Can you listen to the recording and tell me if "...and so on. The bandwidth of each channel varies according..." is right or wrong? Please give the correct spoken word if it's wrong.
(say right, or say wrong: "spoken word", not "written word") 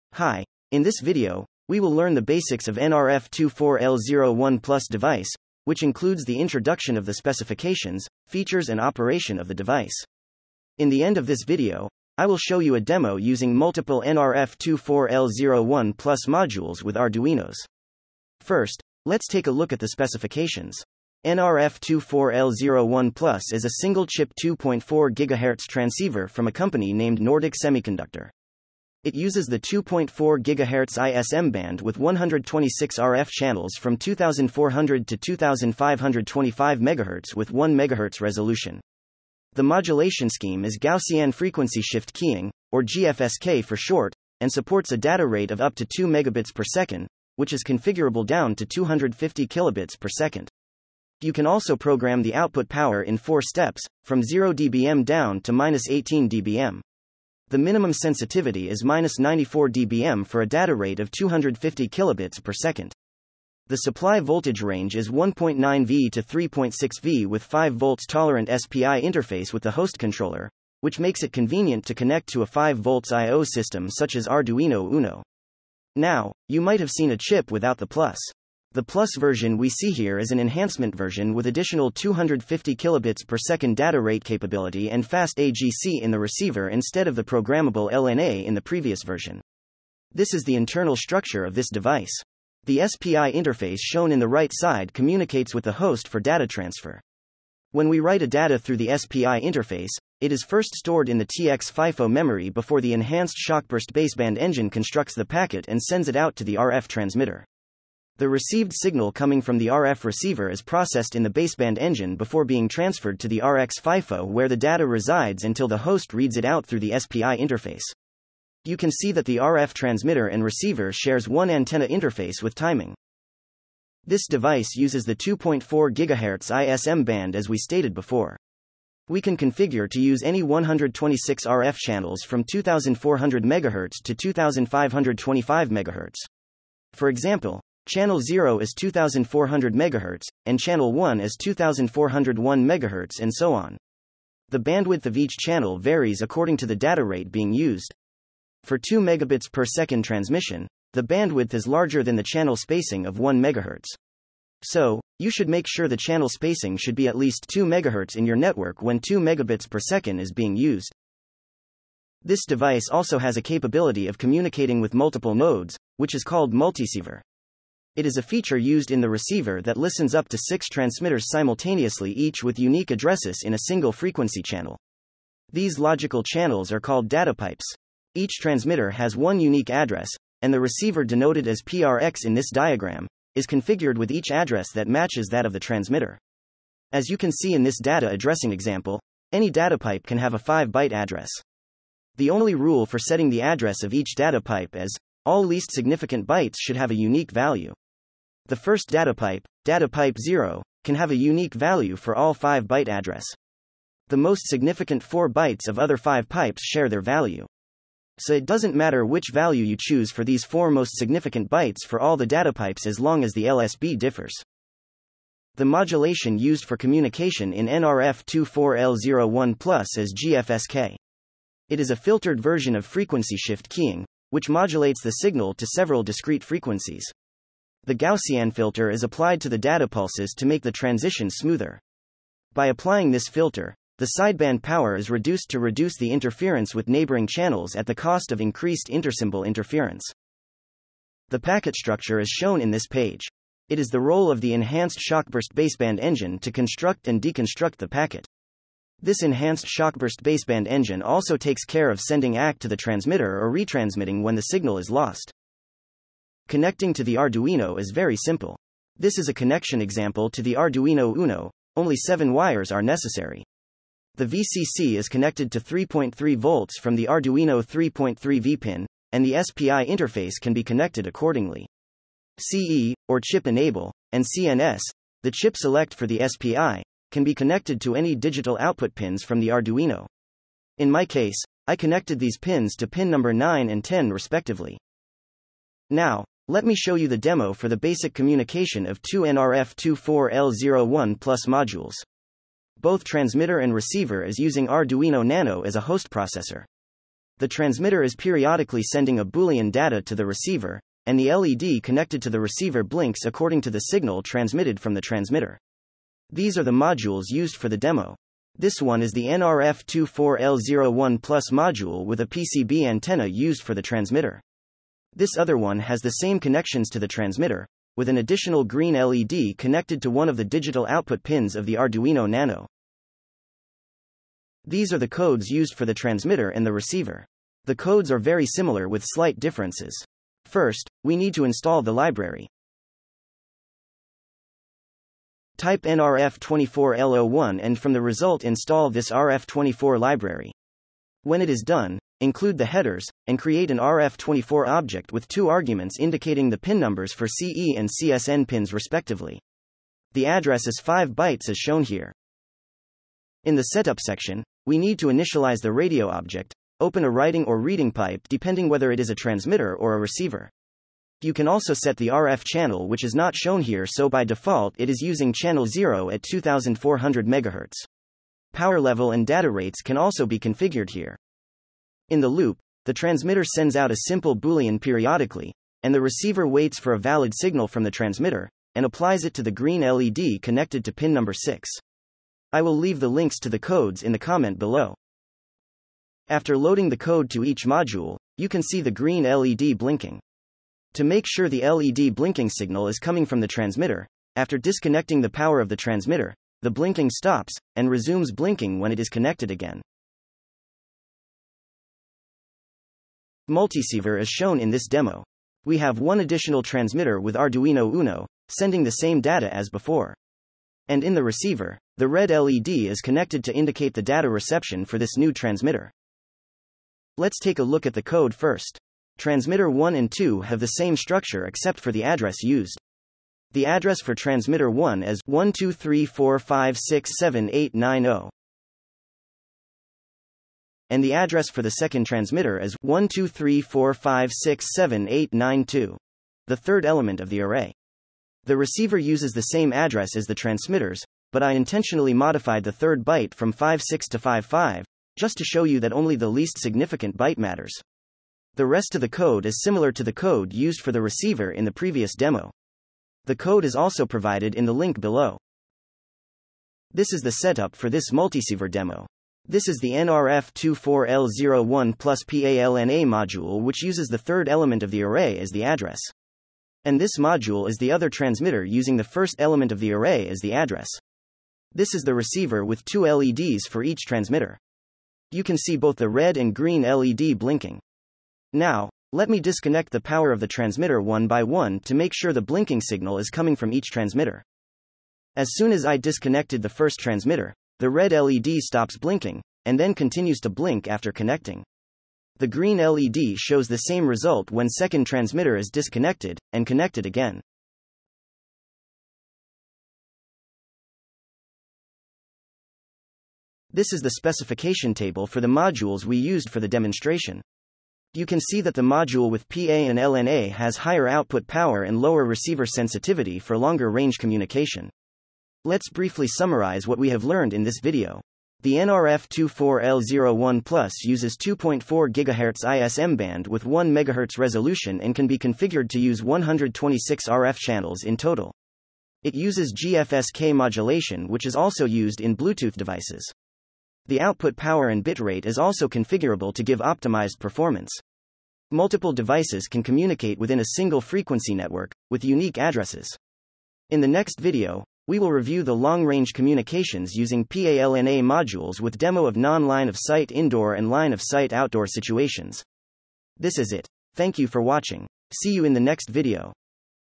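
right.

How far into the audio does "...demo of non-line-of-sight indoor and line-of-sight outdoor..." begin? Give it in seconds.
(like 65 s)
548 s.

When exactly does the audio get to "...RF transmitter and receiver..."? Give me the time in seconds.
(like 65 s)
119 s.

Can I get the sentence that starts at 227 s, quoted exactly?
The Gaussian filter is applied to the data pulses to make the transition smoother.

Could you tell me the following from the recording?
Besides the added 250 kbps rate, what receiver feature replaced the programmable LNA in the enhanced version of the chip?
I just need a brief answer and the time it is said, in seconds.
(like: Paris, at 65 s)
fast AGC, at 85 s.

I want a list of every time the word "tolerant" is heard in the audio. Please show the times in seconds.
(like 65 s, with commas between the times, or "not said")
68 s.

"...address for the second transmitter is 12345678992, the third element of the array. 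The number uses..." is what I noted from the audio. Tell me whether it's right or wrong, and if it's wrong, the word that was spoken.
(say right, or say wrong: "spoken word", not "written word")
wrong: "receiver", not "number".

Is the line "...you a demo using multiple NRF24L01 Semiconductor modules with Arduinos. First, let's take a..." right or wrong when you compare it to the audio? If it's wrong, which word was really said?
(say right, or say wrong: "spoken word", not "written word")
wrong: "Plus", not "Semiconductor".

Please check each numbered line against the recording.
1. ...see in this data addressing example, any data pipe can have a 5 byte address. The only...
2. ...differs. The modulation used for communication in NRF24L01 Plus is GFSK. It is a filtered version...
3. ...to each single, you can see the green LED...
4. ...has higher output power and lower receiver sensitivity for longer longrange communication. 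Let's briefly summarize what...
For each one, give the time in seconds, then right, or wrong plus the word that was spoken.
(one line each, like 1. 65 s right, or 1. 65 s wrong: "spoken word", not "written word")
1. 187 s right
2. 213 s right
3. 387 s wrong: "module", not "single"
4. 510 s wrong: "range", not "longrange".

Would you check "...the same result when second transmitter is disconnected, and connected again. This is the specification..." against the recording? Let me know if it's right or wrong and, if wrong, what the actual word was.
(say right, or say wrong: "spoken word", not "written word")
right.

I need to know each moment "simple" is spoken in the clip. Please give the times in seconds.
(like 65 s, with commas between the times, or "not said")
258 s, 374 s.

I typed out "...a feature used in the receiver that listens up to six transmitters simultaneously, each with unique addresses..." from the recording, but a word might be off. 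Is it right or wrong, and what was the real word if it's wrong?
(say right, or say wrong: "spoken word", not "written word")
right.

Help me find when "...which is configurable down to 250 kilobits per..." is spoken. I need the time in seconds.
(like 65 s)
47 s.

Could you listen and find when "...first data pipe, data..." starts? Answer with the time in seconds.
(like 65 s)
198 s.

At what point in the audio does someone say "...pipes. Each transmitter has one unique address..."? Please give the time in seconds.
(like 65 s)
177 s.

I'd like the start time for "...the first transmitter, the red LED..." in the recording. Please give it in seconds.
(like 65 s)
486 s.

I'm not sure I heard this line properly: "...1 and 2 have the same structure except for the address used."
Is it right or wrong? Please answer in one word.
right.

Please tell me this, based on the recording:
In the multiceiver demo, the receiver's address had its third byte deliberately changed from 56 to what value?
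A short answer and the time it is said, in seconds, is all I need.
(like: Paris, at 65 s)
55, at 444 s.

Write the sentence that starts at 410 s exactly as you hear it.
And in the receiver, the red LED is connected to indicate the data reception for this new transmitter.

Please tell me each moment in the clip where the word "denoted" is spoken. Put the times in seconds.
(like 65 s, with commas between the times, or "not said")
181 s.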